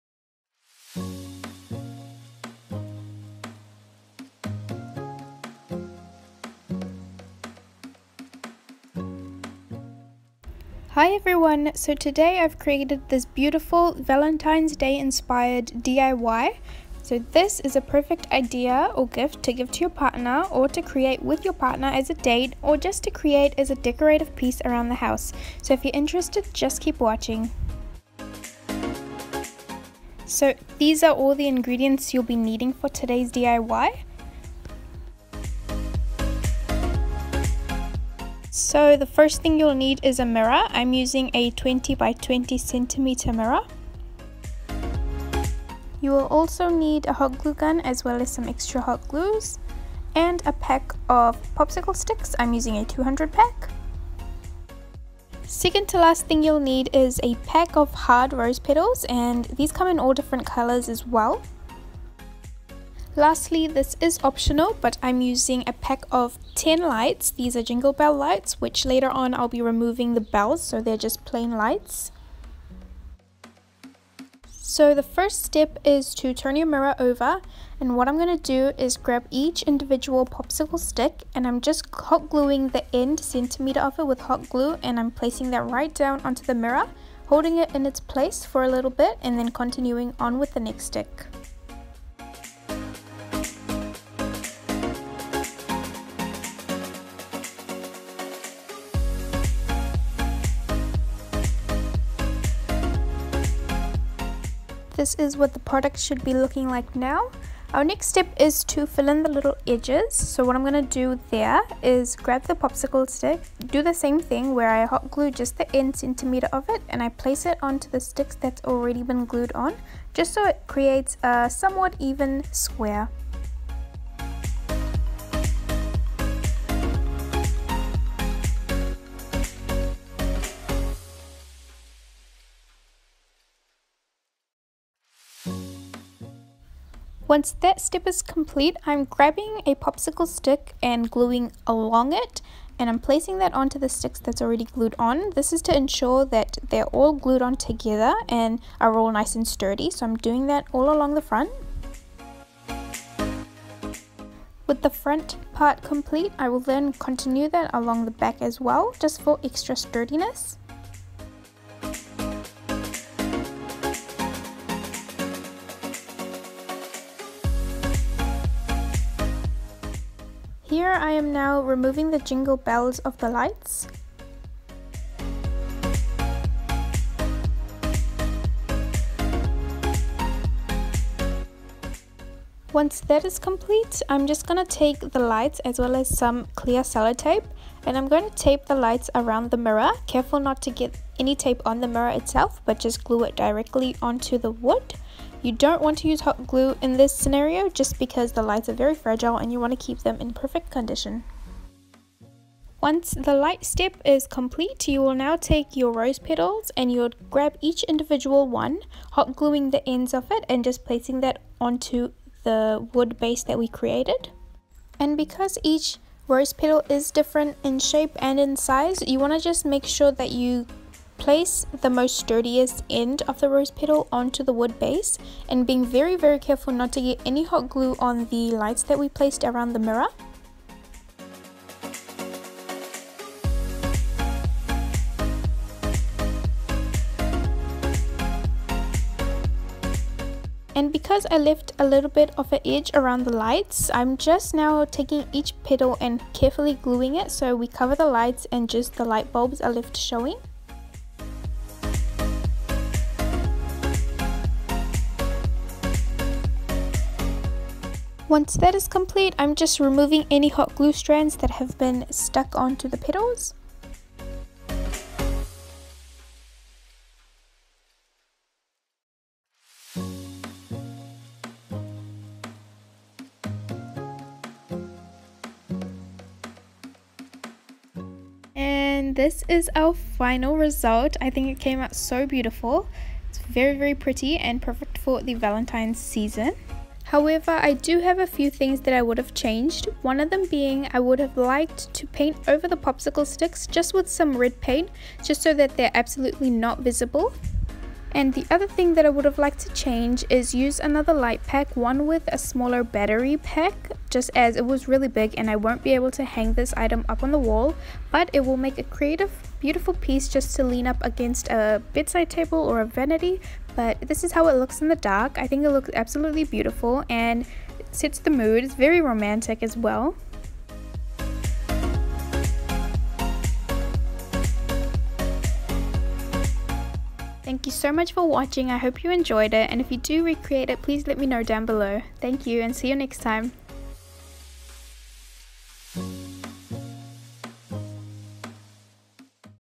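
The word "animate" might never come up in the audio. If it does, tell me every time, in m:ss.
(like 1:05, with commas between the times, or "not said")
not said.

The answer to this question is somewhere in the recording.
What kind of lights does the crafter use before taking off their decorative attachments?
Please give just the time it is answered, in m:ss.
1:07.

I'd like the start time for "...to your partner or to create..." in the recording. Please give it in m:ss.
0:19.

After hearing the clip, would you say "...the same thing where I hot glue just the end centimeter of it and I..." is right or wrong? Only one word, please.
right.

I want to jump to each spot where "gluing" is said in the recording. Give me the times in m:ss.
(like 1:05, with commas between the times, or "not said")
1:22, 2:21, 3:29, 4:06.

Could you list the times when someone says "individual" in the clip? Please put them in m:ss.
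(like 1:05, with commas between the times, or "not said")
1:19, 3:27.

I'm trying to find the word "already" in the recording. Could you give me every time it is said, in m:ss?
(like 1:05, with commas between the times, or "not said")
1:58, 2:24.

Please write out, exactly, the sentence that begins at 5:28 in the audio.
I hope you enjoyed it and if you do recreate it, please let me know down below.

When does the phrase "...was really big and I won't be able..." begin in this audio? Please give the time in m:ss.
5:04.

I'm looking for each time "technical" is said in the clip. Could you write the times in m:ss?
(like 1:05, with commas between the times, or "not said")
not said.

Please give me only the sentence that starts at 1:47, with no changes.
Our next step is to fill in the little edges.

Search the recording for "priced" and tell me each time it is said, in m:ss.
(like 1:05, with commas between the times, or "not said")
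not said.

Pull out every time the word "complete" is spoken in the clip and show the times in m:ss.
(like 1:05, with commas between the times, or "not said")
2:18, 2:35, 3:03, 3:24, 4:18.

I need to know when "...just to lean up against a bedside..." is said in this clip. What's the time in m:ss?
5:10.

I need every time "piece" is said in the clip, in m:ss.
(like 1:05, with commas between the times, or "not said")
0:24, 5:09.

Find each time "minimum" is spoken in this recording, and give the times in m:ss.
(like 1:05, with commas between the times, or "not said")
not said.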